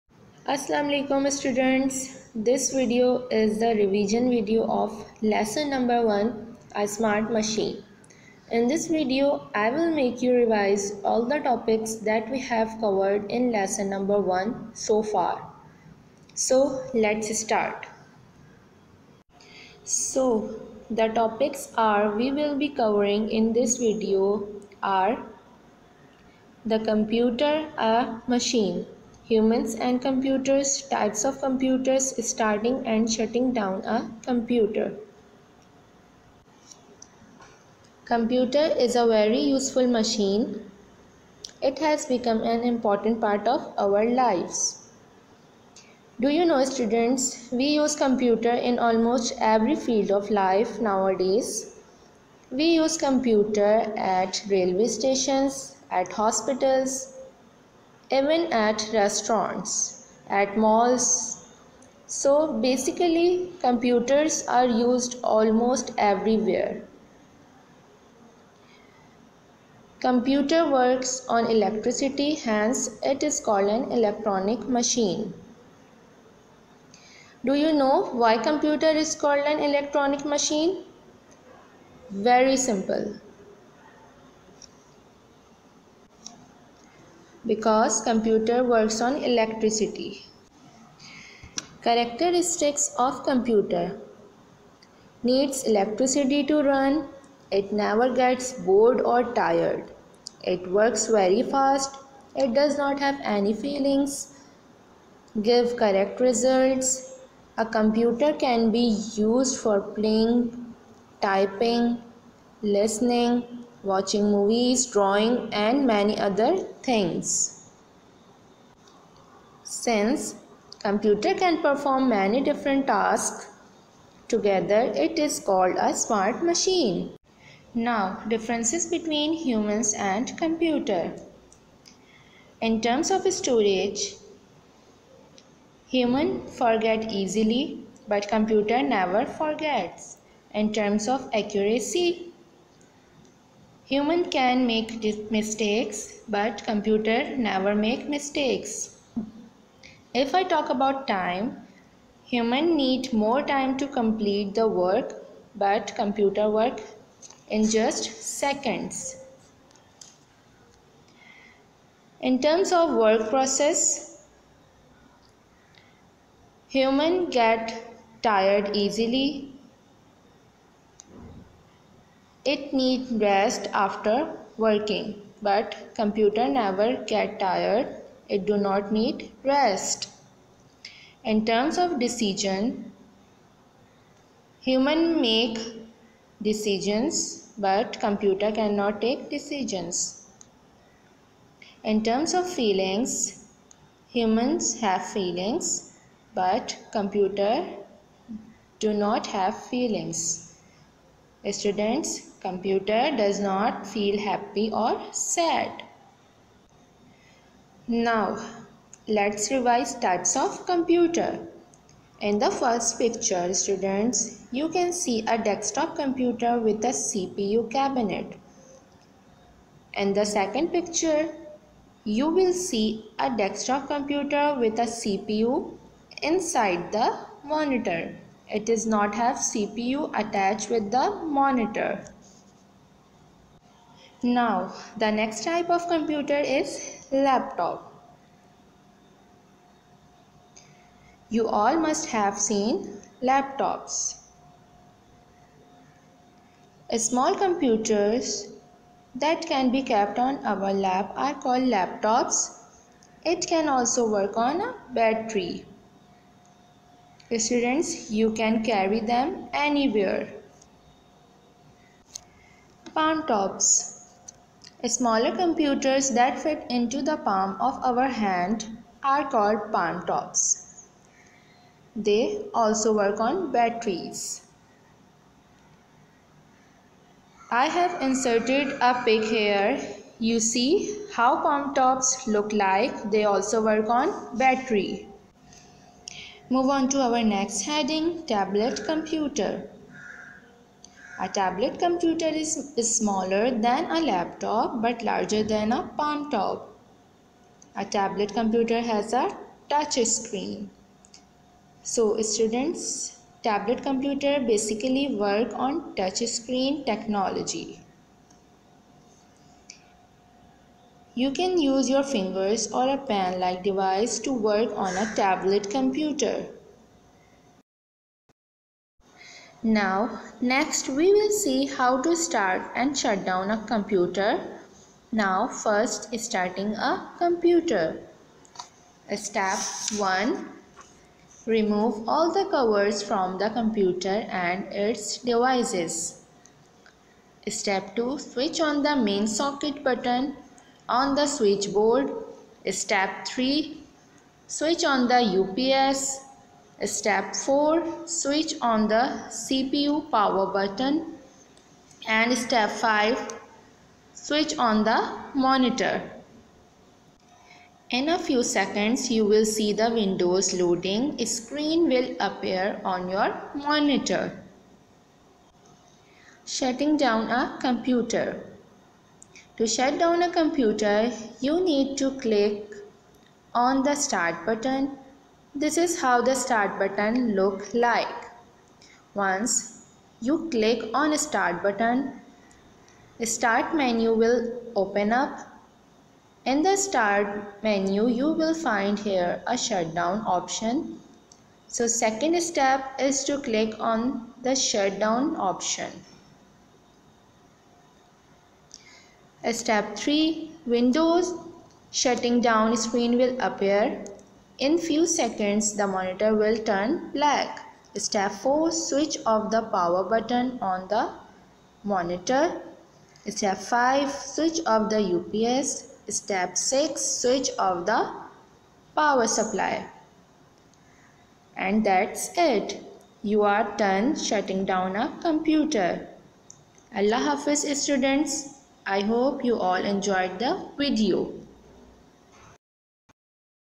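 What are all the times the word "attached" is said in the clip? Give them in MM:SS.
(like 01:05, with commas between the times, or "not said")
03:50.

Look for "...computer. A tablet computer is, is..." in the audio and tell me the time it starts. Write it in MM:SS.
04:48.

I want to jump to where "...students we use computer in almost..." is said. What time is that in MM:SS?
00:46.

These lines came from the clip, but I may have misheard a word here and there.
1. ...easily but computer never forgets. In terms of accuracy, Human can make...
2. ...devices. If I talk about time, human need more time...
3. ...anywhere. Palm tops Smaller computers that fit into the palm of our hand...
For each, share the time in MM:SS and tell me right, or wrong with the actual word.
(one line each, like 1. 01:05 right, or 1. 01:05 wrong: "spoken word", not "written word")
1. 02:17 right
2. 02:28 wrong: "mistakes", not "devices"
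3. 04:19 right.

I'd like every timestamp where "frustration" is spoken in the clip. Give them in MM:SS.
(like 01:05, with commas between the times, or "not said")
not said.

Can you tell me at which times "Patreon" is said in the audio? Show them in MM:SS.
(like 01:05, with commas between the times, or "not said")
not said.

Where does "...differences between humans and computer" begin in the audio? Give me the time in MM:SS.
02:08.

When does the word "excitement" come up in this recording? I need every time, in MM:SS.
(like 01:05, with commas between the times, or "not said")
not said.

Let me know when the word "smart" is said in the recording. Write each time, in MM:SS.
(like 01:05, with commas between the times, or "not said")
00:06, 02:05.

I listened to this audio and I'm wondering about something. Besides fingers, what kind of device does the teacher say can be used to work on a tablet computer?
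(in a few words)
A pen like device.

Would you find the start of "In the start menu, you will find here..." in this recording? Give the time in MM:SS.
06:26.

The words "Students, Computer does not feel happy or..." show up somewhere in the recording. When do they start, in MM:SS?
03:21.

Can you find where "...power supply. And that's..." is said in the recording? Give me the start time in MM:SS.
06:58.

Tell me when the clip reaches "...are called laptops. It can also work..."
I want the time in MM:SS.
04:11.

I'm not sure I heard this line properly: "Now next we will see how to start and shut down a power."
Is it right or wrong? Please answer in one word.
wrong.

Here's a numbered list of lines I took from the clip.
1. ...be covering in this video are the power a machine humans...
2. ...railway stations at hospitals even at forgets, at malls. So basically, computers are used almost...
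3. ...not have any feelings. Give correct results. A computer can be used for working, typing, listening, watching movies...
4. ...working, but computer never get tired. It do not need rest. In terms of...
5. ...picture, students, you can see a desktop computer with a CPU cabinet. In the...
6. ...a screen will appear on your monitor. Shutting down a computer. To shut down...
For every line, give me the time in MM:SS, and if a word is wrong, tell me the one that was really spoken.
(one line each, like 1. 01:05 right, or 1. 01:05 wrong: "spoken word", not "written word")
1. 00:22 wrong: "computer", not "power"
2. 00:54 wrong: "restaurants", not "forgets"
3. 01:42 wrong: "playing", not "working"
4. 02:54 right
5. 03:32 right
6. 06:01 right.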